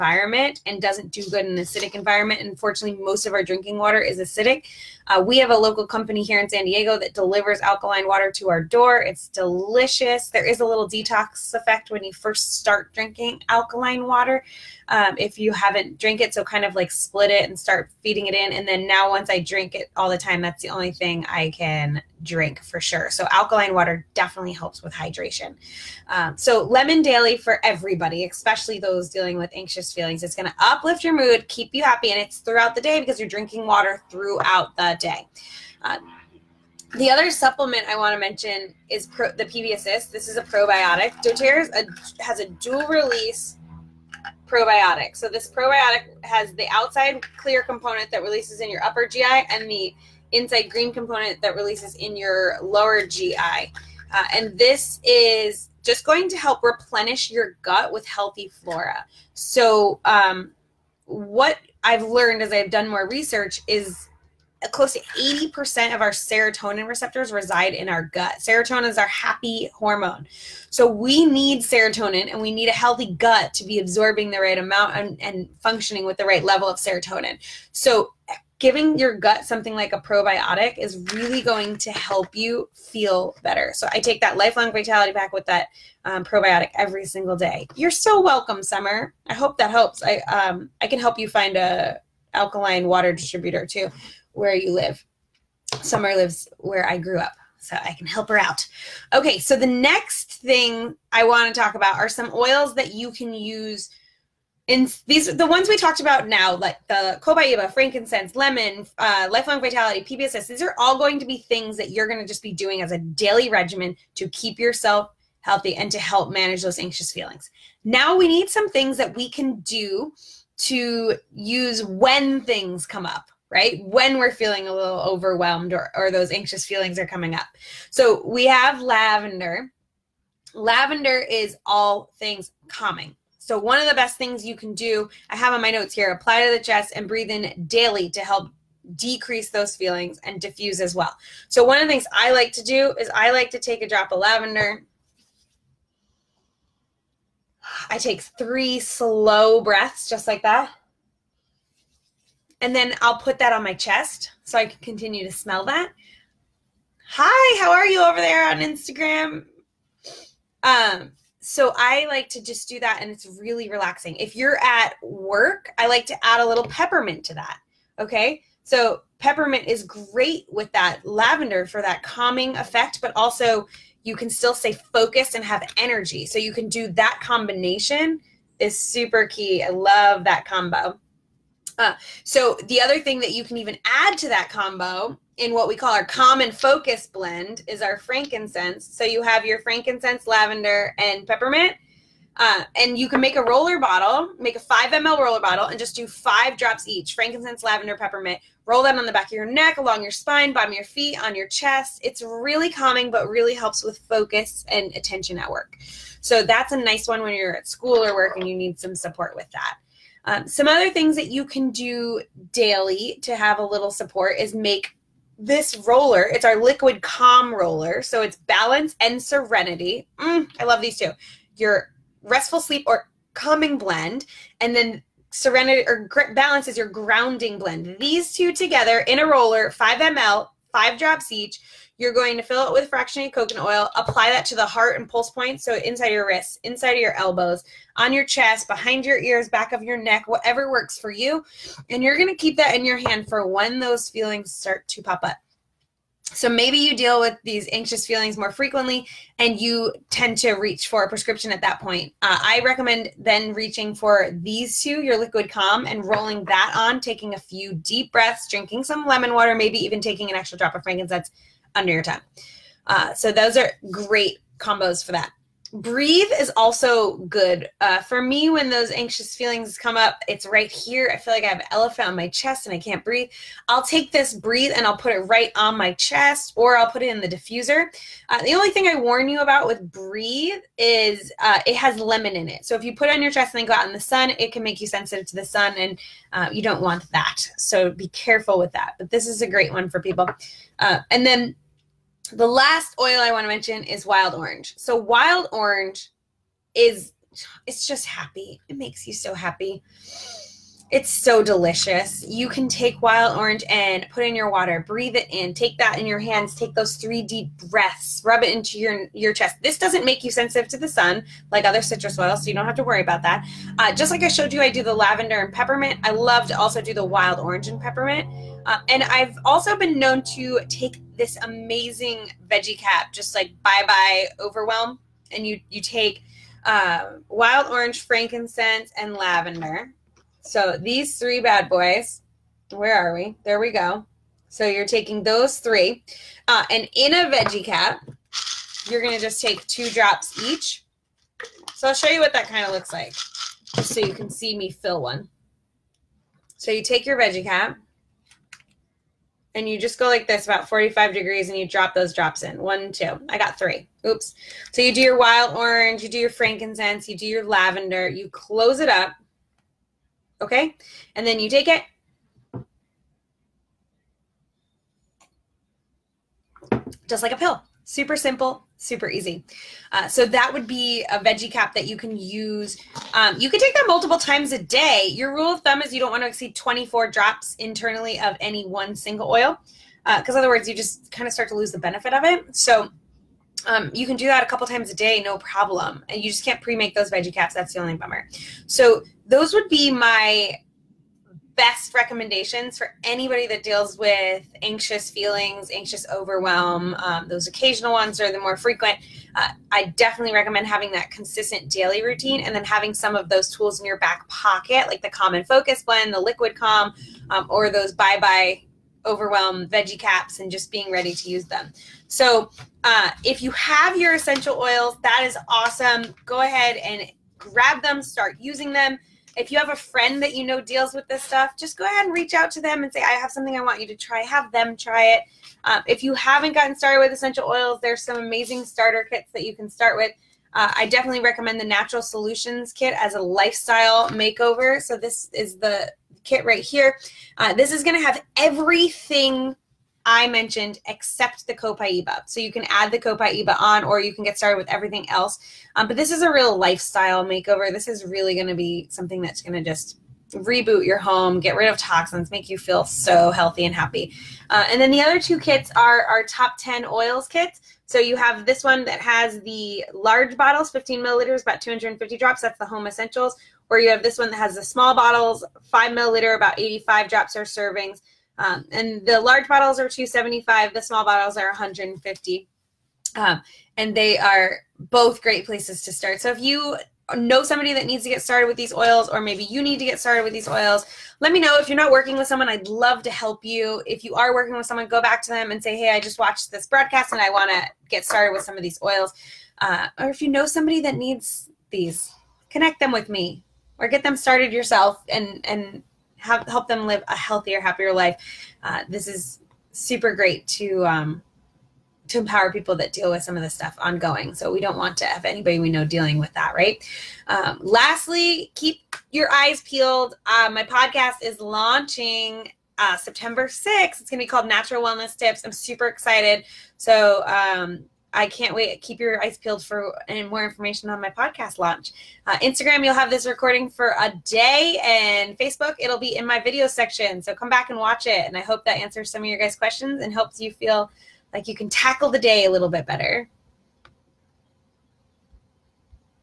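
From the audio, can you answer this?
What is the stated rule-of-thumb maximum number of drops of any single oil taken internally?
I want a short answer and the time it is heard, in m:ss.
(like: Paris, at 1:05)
24 drops, at 6:16.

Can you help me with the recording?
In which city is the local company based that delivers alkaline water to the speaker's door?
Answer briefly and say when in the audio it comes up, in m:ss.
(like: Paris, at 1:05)
San Diego, at 0:06.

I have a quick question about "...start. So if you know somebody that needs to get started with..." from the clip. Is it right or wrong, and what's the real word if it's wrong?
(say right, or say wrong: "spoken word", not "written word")
right.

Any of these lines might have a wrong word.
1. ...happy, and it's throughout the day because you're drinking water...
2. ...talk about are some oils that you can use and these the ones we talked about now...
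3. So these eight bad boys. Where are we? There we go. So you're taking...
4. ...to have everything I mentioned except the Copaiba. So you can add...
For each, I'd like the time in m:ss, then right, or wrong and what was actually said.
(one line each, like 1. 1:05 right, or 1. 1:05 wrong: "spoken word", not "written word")
1. 0:31 right
2. 1:41 right
3. 5:30 wrong: "three", not "eight"
4. 7:17 right.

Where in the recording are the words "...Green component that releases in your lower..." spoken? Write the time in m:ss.
0:50.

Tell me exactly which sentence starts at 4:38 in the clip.
Uh, the only thing I warn you about with breathe is uh, it has lemon in it.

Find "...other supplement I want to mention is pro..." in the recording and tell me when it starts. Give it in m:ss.
0:37.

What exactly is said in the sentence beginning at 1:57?
Now we need some things that we can do to use when things come up right?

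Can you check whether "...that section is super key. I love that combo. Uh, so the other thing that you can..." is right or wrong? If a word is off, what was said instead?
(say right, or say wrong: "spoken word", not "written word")
wrong: "combination", not "section".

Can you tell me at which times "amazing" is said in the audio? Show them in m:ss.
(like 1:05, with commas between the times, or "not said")
5:21, 7:08.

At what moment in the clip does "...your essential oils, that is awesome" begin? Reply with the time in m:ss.
6:53.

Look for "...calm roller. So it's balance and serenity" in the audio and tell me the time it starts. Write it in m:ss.
3:37.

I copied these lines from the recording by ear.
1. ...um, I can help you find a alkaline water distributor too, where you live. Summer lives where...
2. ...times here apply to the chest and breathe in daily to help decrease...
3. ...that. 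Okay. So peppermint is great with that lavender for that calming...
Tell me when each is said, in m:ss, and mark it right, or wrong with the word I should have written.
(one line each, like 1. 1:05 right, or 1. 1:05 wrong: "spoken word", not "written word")
1. 1:30 right
2. 2:15 wrong: "notes", not "times"
3. 2:47 right.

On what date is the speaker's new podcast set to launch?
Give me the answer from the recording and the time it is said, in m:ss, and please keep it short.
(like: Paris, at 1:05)
September 6, at 8:32.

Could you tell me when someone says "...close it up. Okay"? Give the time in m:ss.
5:58.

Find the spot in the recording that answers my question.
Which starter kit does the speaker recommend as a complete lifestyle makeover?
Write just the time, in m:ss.
7:11.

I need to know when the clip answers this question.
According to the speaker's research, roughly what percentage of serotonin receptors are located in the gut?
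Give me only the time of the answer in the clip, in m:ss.
1:05.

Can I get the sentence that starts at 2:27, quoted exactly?
I take three slow breaths, just like that.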